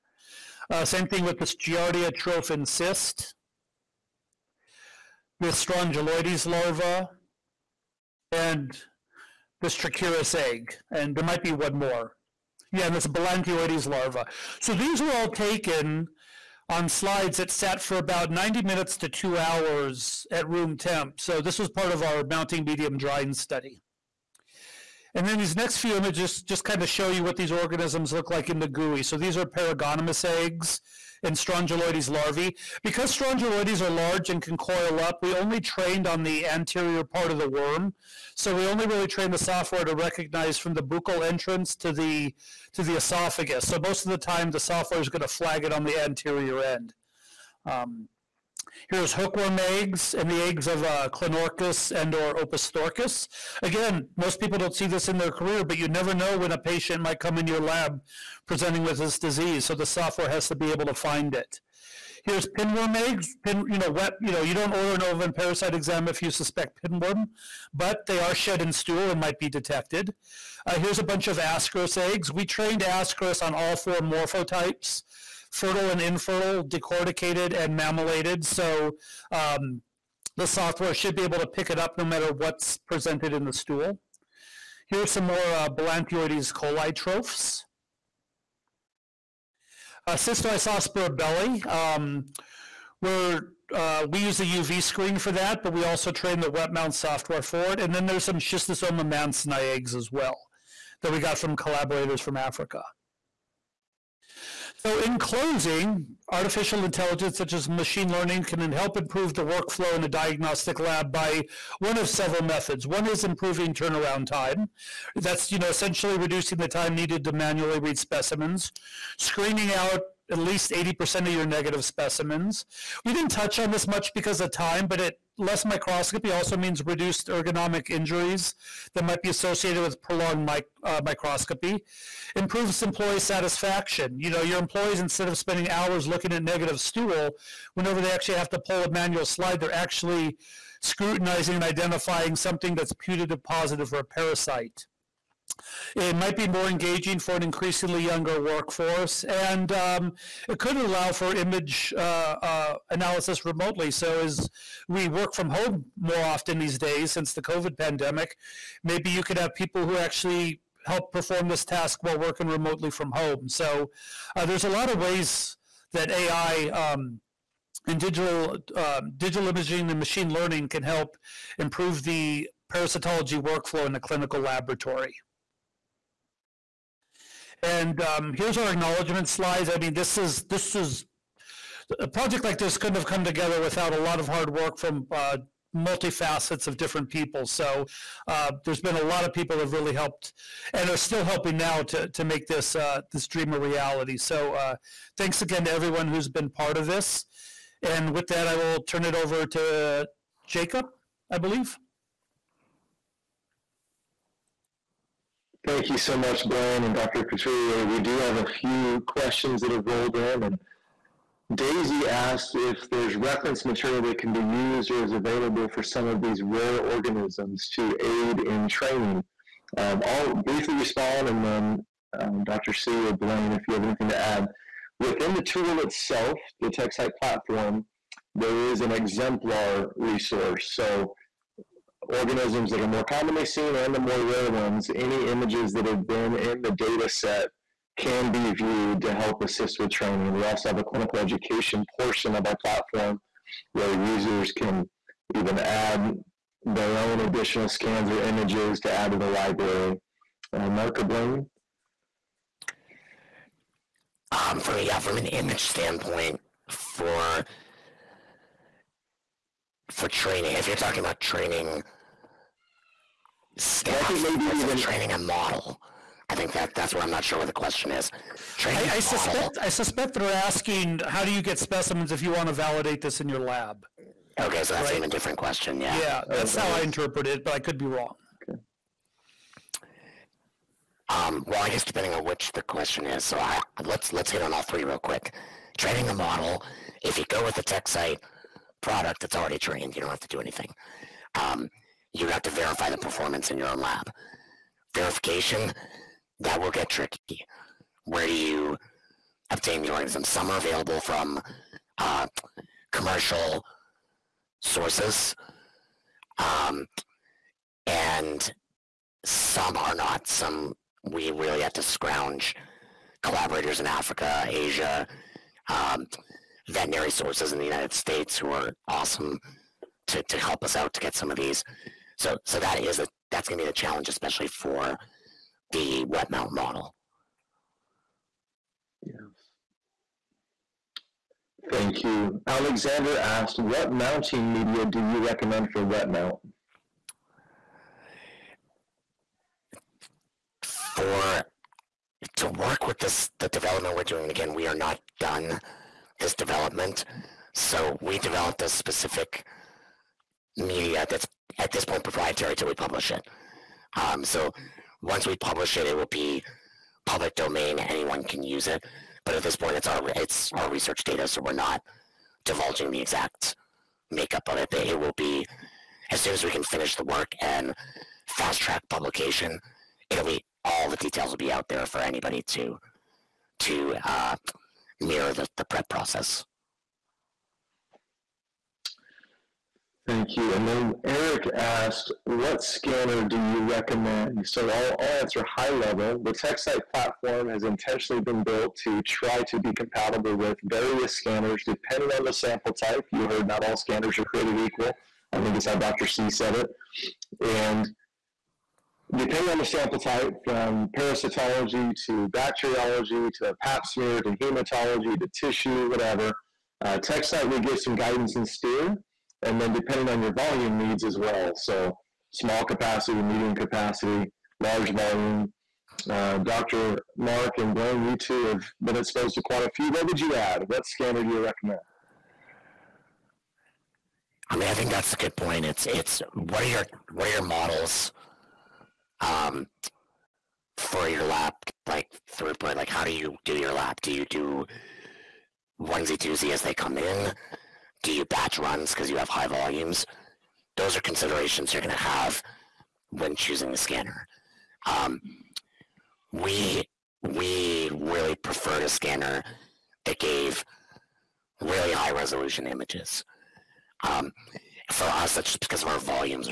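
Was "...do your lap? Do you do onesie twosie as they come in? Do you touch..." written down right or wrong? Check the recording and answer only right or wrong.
wrong.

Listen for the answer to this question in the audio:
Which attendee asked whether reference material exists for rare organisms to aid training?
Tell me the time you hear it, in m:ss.
3:31.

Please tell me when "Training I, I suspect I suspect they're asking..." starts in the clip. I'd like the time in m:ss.
4:28.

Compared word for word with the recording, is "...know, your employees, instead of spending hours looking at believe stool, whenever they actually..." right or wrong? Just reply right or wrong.
wrong.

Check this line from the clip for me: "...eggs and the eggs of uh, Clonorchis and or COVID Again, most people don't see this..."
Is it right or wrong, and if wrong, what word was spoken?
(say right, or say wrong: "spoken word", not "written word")
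wrong: "Opisthorchis", not "COVID".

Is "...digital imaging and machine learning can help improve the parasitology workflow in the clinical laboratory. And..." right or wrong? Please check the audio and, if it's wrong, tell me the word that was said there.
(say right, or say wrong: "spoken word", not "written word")
right.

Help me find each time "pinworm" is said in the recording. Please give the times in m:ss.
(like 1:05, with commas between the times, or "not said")
1:02, 1:06.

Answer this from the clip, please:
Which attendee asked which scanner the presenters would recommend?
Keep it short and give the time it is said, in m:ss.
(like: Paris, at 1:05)
Eric, at 6:21.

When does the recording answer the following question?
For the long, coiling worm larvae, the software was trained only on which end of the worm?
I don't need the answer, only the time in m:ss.
0:36.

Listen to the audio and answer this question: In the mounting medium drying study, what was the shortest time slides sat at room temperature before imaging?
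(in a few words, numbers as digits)
90 minutes.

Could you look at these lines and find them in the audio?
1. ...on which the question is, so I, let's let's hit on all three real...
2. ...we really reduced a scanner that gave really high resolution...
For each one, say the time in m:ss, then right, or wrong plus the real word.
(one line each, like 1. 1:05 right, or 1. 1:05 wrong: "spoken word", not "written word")
1. 4:42 right
2. 7:27 wrong: "preferred", not "reduced".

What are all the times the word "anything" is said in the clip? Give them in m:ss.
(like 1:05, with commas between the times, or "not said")
3:43, 4:50.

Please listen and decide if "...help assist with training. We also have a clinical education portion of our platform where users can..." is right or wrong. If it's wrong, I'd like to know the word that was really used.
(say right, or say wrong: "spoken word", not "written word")
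right.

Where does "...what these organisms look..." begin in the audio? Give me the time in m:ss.
0:27.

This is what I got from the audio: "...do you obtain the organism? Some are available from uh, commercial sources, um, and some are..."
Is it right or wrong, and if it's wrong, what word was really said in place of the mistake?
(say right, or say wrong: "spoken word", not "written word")
right.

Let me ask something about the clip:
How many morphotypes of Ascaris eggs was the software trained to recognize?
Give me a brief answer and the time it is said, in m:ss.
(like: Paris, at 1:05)
4, at 1:13.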